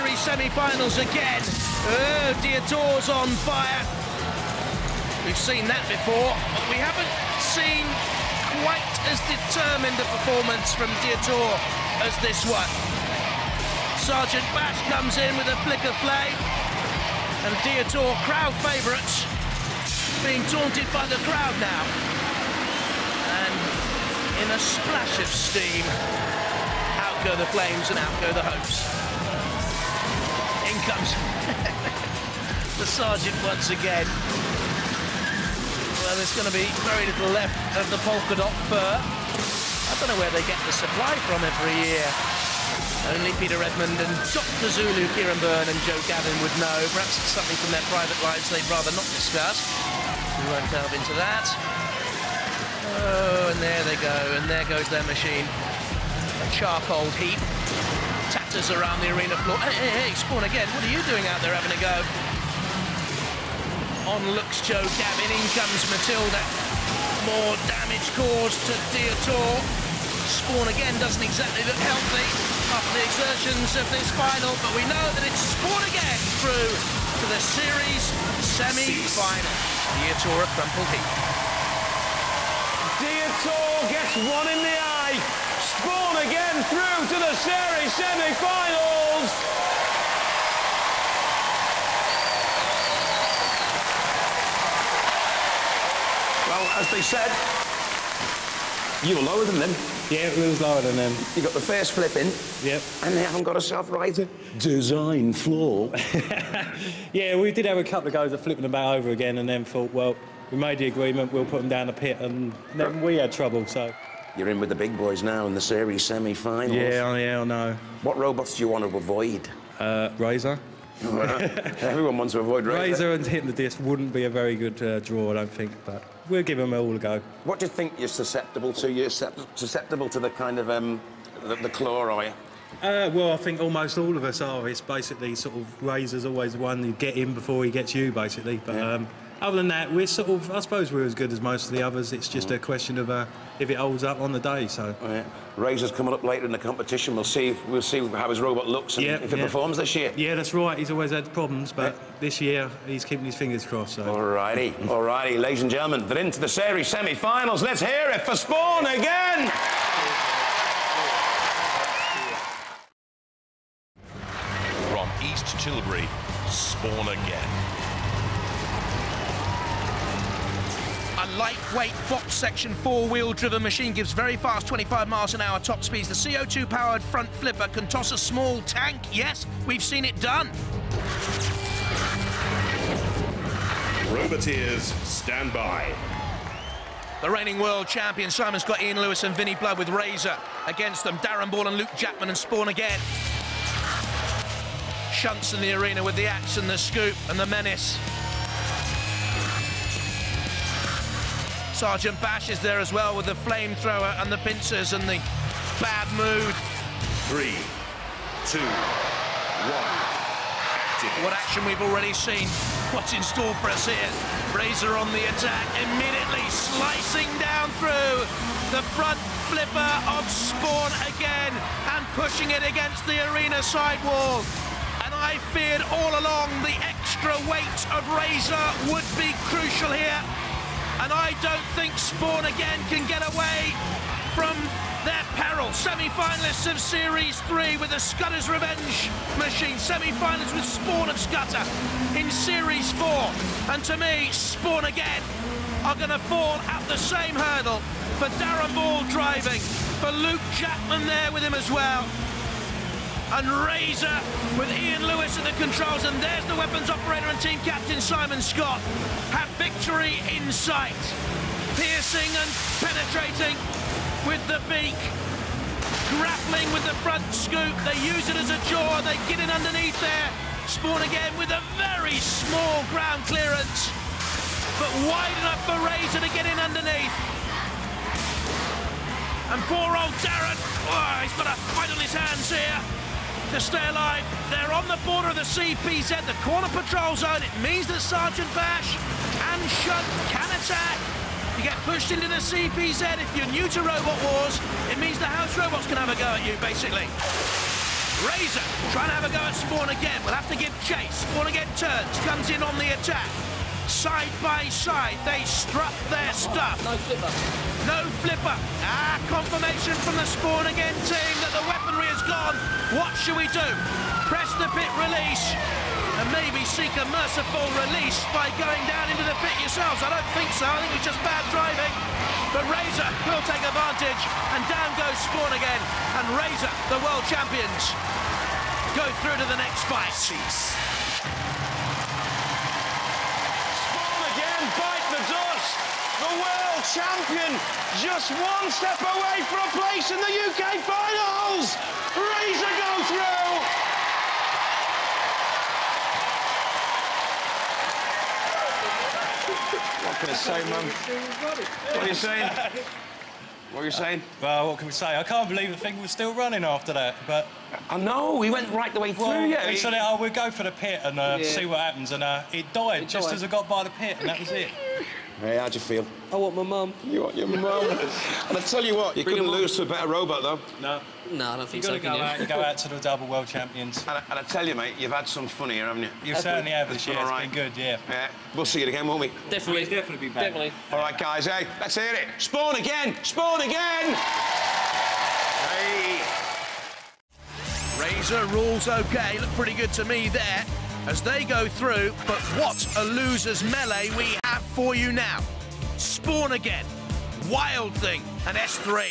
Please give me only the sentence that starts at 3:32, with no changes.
What's in store for us here?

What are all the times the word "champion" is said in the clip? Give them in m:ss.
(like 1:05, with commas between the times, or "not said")
3:07, 5:27, 5:36, 6:13.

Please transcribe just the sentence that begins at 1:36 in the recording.
Well, as they said, you were lower than them.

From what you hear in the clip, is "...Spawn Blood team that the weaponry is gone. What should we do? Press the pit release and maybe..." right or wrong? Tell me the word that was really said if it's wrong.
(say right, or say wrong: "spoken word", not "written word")
wrong: "Again", not "Blood".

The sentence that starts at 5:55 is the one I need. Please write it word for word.
I can't believe the thing was still running after that, but...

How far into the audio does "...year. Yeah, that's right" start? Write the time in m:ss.
2:29.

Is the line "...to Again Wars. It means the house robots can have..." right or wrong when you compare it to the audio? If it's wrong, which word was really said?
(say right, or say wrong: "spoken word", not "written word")
wrong: "Robot", not "Again".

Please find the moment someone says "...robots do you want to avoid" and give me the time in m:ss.
1:58.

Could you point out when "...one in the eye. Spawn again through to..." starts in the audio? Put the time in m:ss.
1:24.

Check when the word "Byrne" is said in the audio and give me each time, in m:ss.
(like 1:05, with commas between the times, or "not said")
0:45.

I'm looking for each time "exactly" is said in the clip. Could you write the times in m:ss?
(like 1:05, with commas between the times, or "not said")
1:11.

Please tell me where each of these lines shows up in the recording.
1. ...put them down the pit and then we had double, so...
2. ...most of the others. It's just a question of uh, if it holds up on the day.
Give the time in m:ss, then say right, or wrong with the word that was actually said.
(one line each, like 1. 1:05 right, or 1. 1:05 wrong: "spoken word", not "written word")
1. 1:51 wrong: "trouble", not "double"
2. 2:21 right.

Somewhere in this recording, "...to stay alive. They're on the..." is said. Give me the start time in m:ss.
4:43.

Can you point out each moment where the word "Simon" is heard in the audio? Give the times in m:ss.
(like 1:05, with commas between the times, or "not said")
3:08, 4:17.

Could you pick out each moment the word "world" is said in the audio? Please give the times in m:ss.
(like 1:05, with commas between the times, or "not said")
3:07, 5:27, 5:36, 6:13.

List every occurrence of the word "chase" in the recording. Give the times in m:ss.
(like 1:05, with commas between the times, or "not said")
5:00.